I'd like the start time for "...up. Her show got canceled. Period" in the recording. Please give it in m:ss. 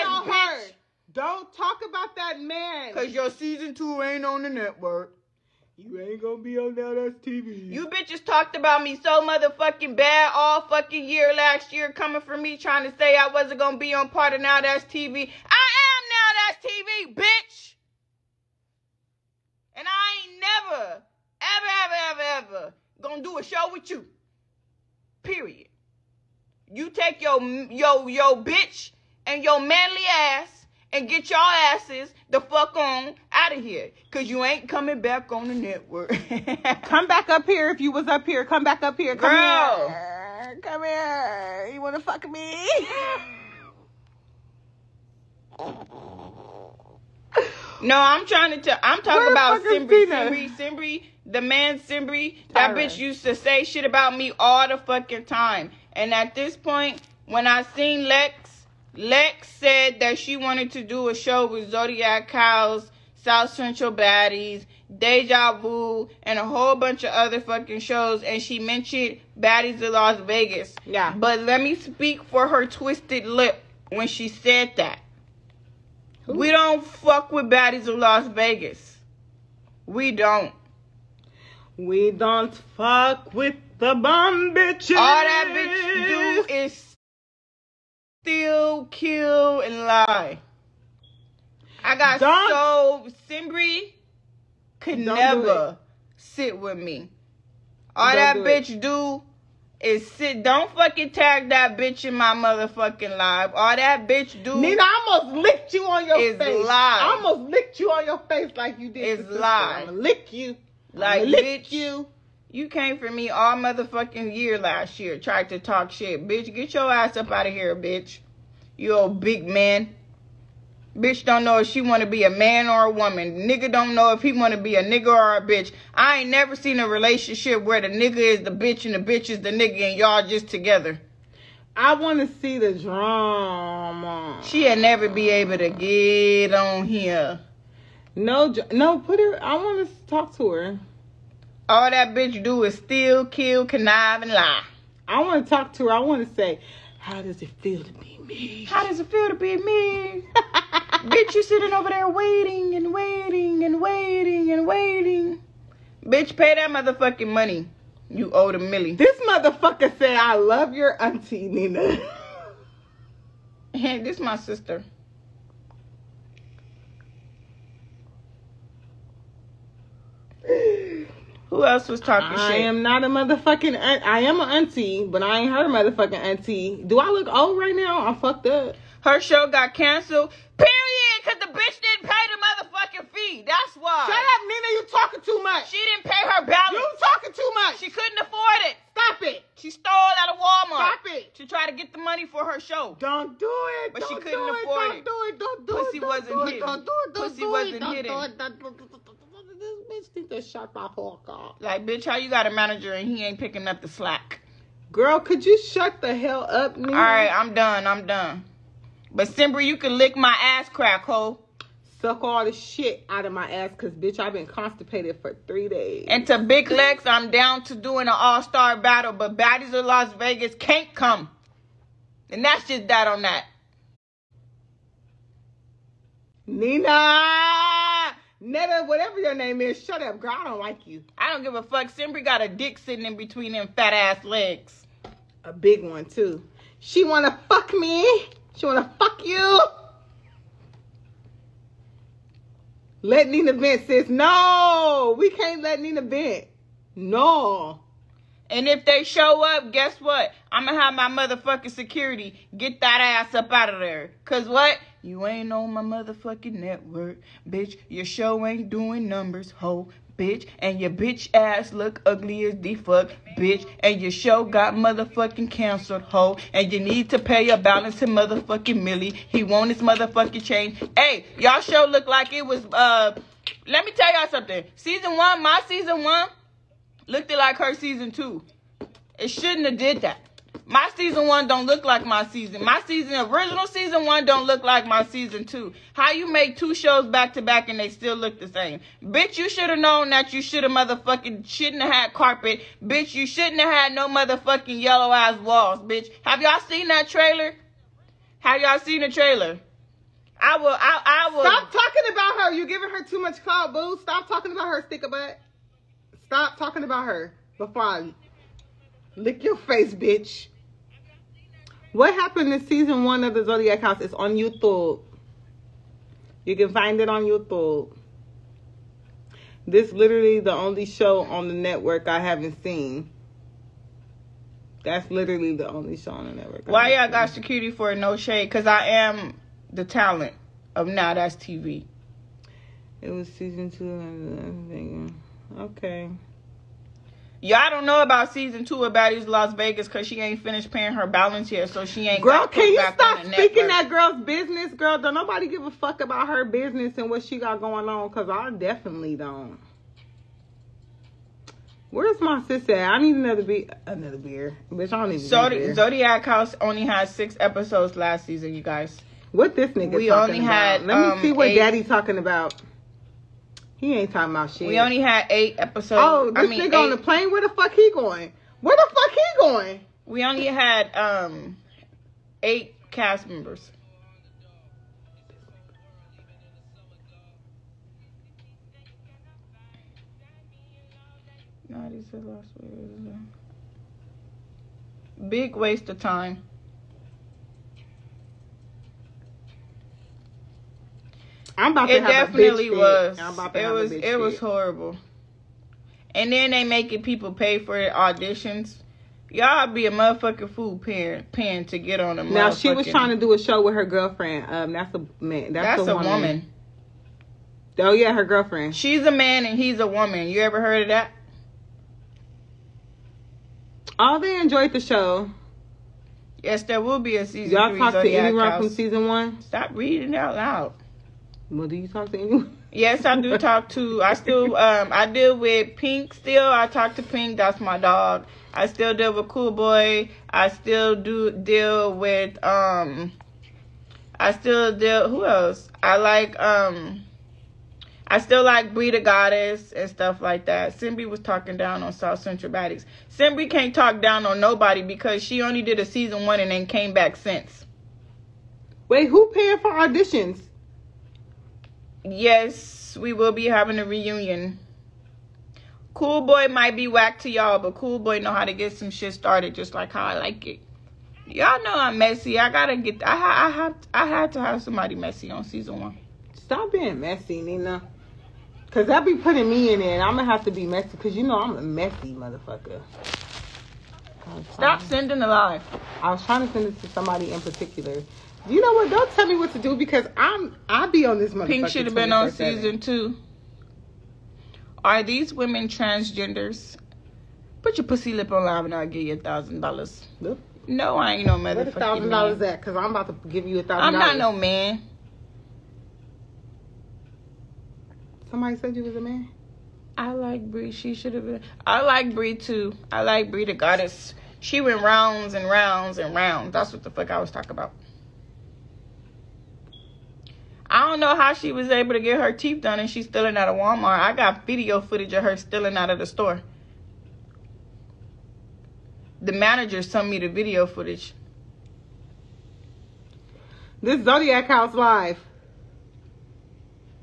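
2:58.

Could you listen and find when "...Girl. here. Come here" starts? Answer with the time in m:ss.
0:39.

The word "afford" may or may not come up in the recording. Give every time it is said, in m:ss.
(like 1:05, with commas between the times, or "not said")
3:08, 3:14.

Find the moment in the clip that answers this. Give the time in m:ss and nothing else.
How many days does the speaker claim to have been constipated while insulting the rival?
3:35.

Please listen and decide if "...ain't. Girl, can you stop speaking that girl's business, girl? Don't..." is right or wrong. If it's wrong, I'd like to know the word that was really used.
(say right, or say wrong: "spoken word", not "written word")
right.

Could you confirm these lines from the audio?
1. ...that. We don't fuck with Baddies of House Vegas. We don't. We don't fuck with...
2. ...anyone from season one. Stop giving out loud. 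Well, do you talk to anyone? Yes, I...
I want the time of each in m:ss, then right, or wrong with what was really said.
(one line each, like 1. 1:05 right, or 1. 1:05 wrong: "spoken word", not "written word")
1. 1:14 wrong: "Las", not "House"
2. 6:58 wrong: "reading", not "giving".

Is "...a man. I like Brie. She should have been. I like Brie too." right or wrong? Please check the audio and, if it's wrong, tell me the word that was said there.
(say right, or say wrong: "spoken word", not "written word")
right.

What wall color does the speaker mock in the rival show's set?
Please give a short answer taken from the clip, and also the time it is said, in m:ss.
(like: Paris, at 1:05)
Yellow, at 4:54.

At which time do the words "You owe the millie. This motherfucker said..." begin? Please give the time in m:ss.
2:38.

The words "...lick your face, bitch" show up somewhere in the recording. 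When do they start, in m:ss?
5:09.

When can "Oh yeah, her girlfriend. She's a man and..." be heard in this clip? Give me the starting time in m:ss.
6:47.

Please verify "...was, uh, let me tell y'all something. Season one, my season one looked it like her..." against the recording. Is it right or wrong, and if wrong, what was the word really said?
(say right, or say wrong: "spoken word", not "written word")
right.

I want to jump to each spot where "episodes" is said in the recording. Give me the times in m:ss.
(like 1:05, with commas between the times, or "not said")
5:57, 6:05.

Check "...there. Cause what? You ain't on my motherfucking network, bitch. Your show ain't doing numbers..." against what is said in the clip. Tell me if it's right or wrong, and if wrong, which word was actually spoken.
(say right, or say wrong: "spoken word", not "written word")
right.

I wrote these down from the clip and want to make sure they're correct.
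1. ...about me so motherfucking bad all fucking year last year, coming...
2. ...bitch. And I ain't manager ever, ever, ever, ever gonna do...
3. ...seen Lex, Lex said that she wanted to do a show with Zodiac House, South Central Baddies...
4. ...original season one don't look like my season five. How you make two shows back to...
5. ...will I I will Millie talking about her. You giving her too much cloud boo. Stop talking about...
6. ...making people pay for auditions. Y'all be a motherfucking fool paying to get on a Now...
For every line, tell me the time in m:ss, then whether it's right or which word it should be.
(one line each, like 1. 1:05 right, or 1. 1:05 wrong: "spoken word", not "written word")
1. 0:08 right
2. 0:17 wrong: "never", not "manager"
3. 0:57 right
4. 4:43 wrong: "two", not "five"
5. 5:00 wrong: "Stop", not "Millie"
6. 6:36 right.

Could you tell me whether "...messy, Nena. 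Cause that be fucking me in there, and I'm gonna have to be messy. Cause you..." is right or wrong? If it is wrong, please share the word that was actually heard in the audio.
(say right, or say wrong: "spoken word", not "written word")
wrong: "putting", not "fucking".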